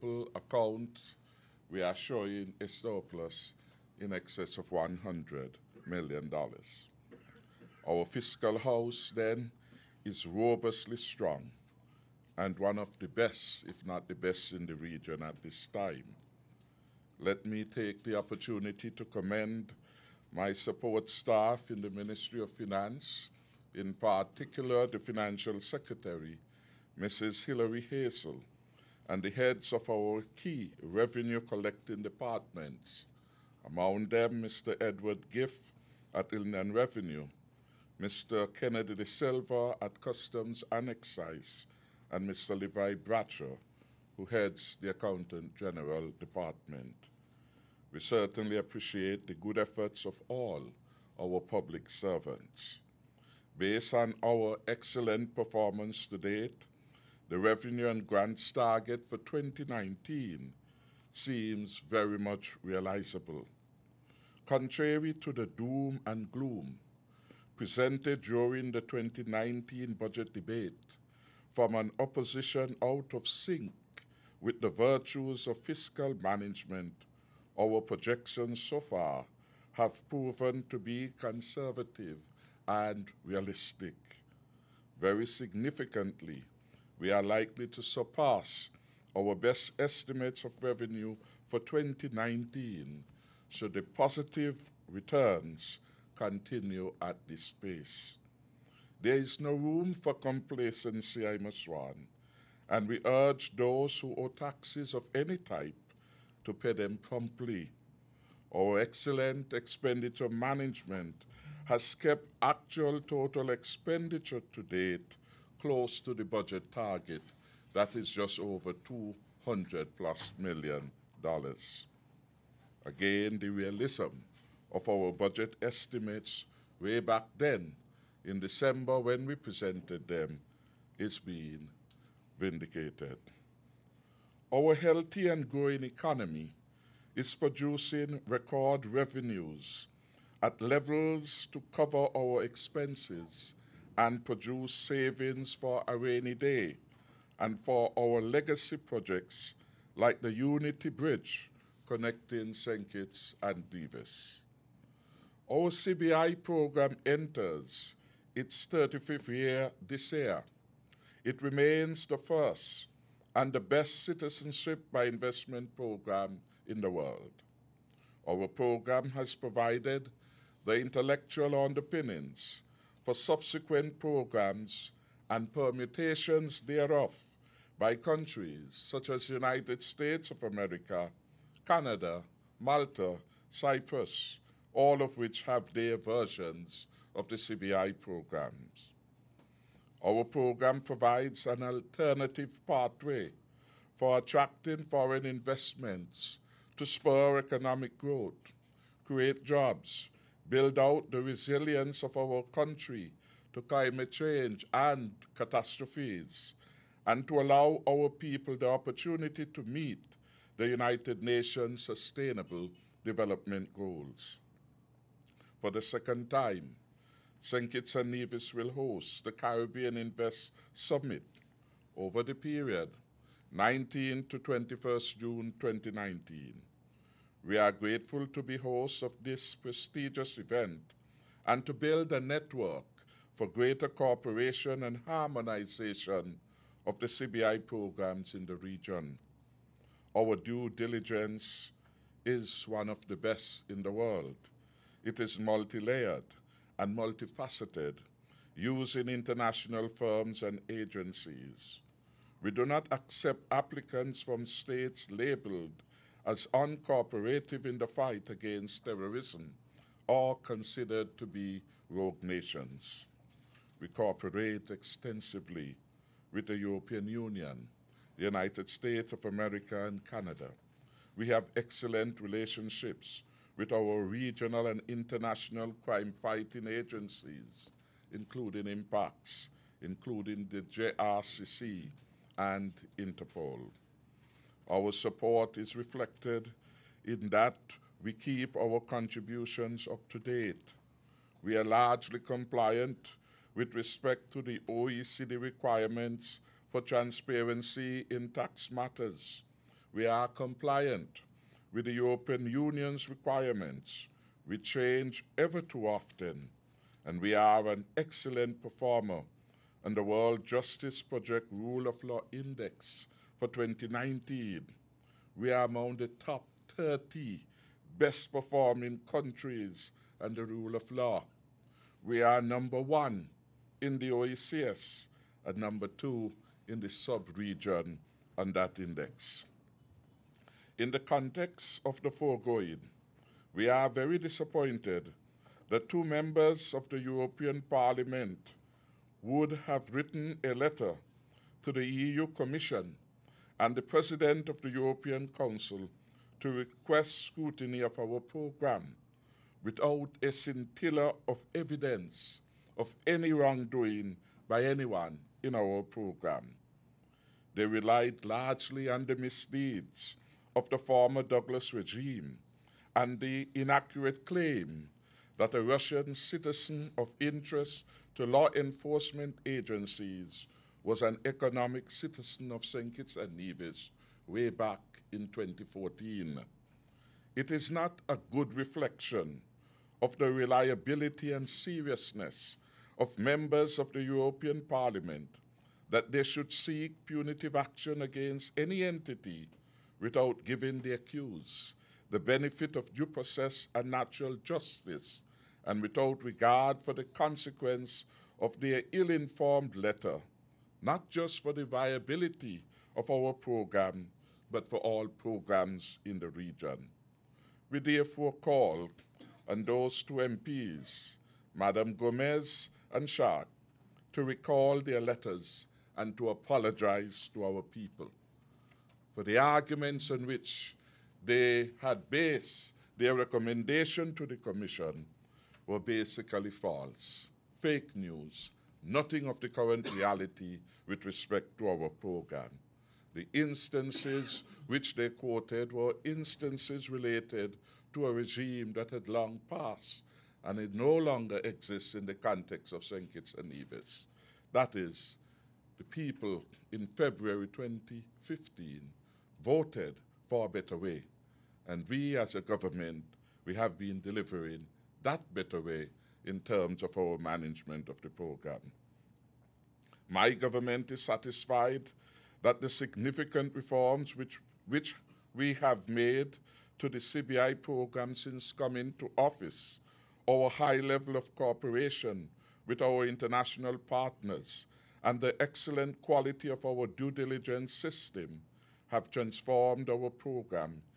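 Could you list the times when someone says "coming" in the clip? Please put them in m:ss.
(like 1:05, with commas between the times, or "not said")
7:48.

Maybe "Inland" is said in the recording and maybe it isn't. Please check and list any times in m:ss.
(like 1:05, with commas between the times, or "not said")
0:36.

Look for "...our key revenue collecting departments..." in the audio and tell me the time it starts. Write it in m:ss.
0:29.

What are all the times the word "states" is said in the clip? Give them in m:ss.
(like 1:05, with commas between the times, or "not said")
2:59, 4:14, 4:28.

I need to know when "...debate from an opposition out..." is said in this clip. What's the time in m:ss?
1:10.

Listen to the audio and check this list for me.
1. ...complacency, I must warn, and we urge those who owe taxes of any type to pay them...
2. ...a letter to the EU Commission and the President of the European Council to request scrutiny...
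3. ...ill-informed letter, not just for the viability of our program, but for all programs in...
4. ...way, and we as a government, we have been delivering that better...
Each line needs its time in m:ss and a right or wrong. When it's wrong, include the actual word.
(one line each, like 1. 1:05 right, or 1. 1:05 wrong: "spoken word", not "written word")
1. 1:40 right
2. 5:40 right
3. 6:38 right
4. 7:30 right.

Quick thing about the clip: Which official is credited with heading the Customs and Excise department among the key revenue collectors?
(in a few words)
Kennedy De Silva.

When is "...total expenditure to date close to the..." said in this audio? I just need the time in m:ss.
1:53.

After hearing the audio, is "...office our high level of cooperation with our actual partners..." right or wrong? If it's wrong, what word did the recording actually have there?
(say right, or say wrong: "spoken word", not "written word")
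wrong: "international", not "actual".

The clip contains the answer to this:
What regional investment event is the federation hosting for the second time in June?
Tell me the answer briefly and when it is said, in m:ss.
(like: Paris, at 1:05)
Caribbean Invest Summit, at 3:39.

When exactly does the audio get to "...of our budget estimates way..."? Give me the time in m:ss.
2:04.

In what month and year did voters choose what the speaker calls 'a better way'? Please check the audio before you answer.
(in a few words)
February 2015.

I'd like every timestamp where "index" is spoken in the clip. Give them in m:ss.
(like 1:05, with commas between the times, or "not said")
5:12, 5:28.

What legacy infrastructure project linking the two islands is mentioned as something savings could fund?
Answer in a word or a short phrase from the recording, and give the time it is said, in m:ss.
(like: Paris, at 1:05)
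Unity Bridge, at 2:30.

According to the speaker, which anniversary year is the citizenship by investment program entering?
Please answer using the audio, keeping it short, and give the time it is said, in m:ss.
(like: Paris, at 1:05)
35th, at 2:38.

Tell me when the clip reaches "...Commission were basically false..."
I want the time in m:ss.
7:04.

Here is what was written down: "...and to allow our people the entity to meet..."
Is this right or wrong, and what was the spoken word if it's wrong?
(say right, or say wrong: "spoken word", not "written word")
wrong: "opportunity", not "entity".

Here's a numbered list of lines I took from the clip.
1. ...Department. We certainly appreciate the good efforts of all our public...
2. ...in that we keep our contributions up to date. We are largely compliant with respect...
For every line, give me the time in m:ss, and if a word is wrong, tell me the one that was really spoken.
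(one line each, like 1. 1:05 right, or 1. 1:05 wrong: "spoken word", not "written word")
1. 0:46 right
2. 4:47 right.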